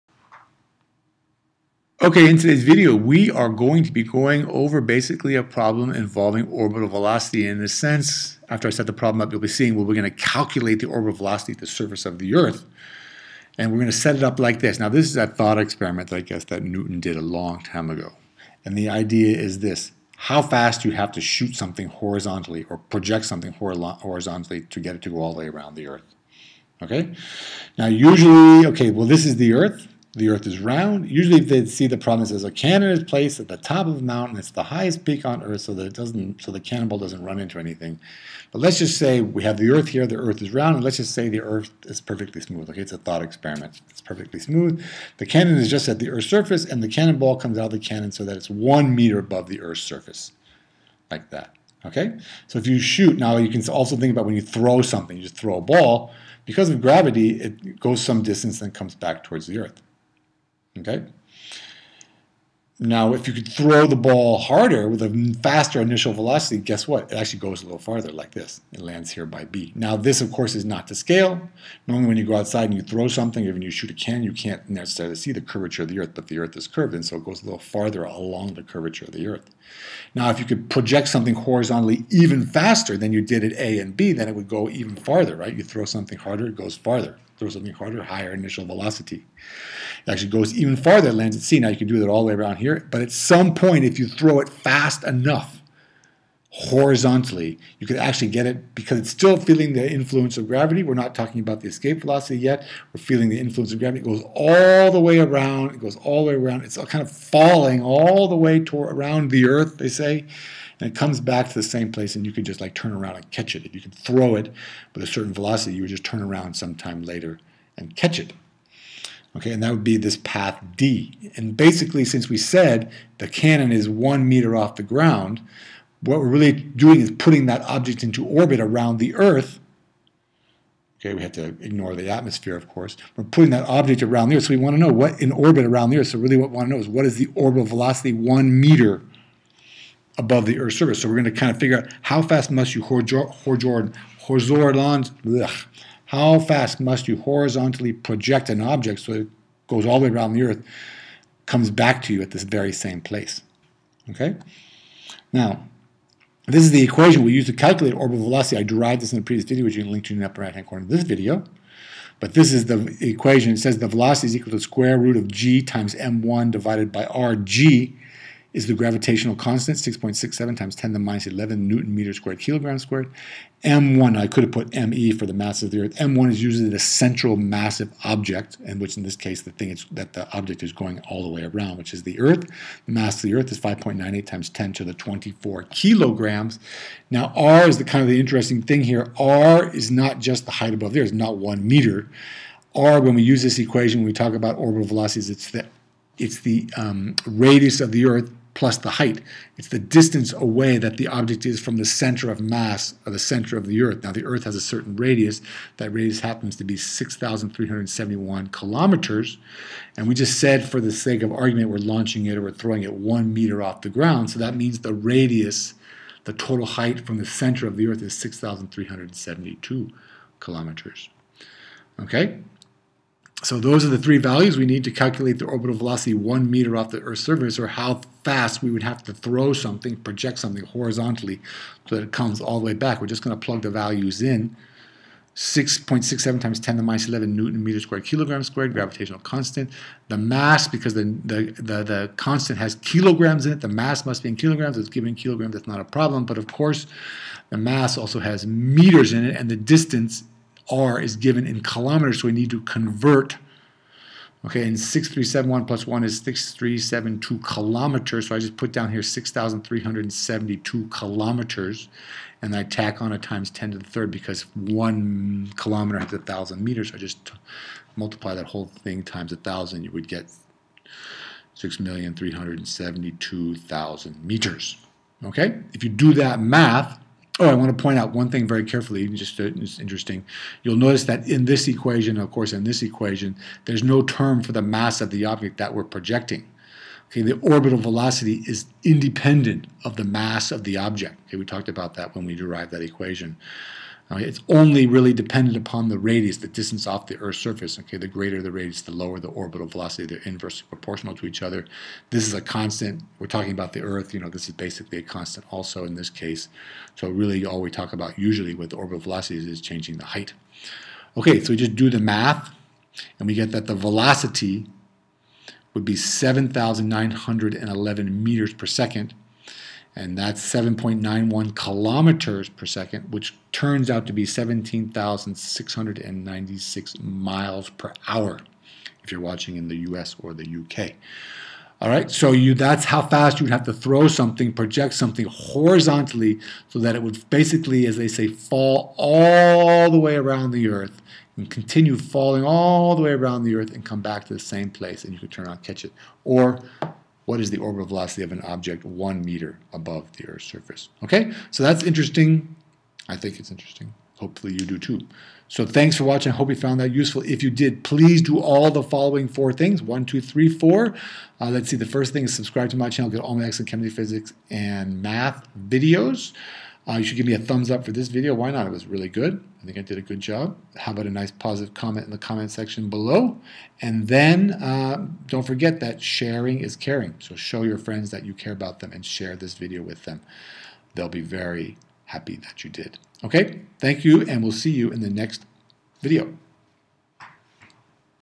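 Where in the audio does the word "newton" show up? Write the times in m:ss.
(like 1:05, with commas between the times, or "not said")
0:16, 2:51, 3:57.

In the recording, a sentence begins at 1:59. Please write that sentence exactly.
Okay, and that would be this path D.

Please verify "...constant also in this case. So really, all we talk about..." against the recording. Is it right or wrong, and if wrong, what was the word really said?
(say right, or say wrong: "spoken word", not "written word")
right.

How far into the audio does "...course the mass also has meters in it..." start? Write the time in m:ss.
4:06.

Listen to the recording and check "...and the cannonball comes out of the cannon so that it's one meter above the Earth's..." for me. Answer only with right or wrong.
right.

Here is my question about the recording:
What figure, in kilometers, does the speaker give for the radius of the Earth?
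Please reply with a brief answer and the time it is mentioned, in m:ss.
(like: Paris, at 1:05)
6,371 km, at 3:26.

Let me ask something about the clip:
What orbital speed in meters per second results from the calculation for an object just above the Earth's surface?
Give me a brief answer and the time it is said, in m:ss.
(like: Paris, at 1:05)
7,911 m/s, at 5:15.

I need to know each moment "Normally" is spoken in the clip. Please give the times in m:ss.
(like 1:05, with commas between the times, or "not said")
1:11.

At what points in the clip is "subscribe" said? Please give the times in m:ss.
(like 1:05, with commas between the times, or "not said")
6:02.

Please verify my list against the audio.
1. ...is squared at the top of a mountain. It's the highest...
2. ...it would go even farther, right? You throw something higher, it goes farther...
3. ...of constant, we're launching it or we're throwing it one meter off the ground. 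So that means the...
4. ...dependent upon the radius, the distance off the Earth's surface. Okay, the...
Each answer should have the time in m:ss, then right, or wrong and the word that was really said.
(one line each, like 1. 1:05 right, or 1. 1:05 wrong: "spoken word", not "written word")
1. 0:32 wrong: "placed", not "squared"
2. 1:24 wrong: "harder", not "higher"
3. 3:31 wrong: "argument", not "constant"
4. 4:55 right.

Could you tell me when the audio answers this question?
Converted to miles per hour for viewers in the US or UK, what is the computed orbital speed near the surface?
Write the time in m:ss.
5:24.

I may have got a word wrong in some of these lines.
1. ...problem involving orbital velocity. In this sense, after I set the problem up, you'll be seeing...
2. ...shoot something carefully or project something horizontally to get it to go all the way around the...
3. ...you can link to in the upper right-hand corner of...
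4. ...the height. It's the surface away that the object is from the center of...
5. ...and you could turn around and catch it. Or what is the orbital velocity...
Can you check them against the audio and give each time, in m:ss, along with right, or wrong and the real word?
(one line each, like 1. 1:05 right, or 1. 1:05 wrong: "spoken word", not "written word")
1. 0:05 right
2. 0:21 wrong: "horizontally", not "carefully"
3. 2:39 right
4. 3:18 wrong: "distance", not "surface"
5. 5:45 right.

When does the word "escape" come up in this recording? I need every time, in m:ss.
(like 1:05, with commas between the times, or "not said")
1:41.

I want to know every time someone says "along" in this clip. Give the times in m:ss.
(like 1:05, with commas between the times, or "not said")
1:18.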